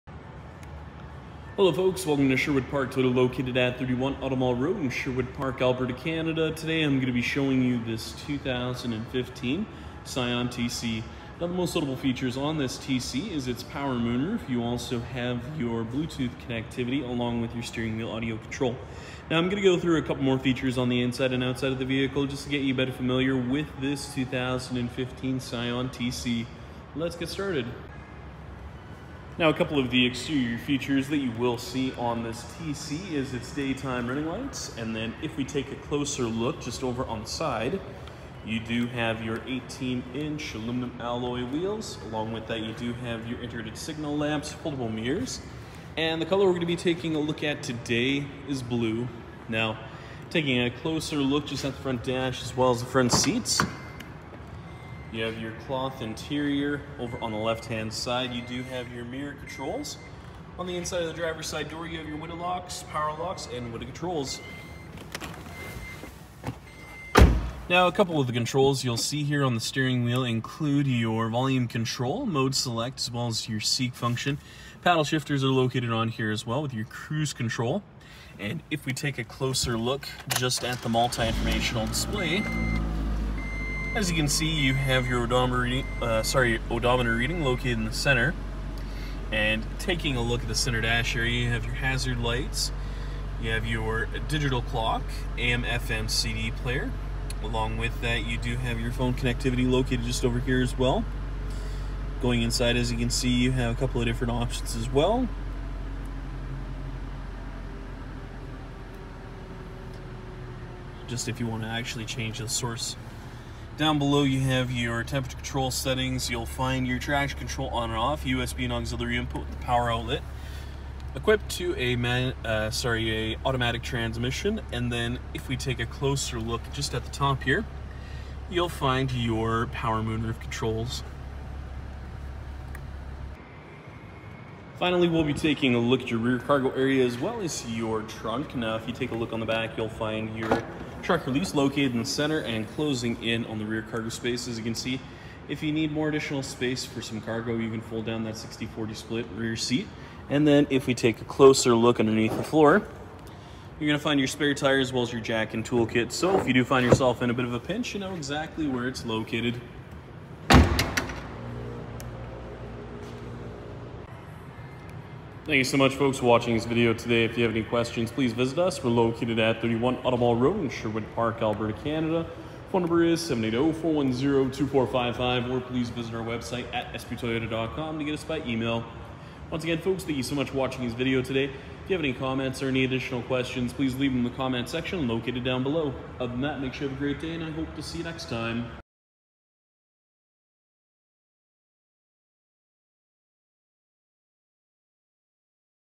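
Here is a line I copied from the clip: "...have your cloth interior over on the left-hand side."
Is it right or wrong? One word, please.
right.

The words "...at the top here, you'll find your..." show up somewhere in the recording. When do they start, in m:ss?
2:06.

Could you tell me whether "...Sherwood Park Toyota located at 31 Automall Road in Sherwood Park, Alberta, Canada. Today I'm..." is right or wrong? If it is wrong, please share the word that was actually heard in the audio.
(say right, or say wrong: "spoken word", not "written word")
right.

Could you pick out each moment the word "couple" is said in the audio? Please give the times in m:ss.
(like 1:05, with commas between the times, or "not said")
0:20, 0:29, 1:07, 1:43.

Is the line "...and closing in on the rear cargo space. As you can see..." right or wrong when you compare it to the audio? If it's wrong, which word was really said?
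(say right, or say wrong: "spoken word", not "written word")
right.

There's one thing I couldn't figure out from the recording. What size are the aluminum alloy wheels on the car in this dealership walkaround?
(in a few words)
18-inch.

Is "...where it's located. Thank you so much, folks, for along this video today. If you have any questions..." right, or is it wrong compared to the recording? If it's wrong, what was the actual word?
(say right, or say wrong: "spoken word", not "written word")
wrong: "watching", not "along".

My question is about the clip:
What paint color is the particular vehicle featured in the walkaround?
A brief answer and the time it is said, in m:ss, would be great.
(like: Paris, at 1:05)
Blue, at 0:48.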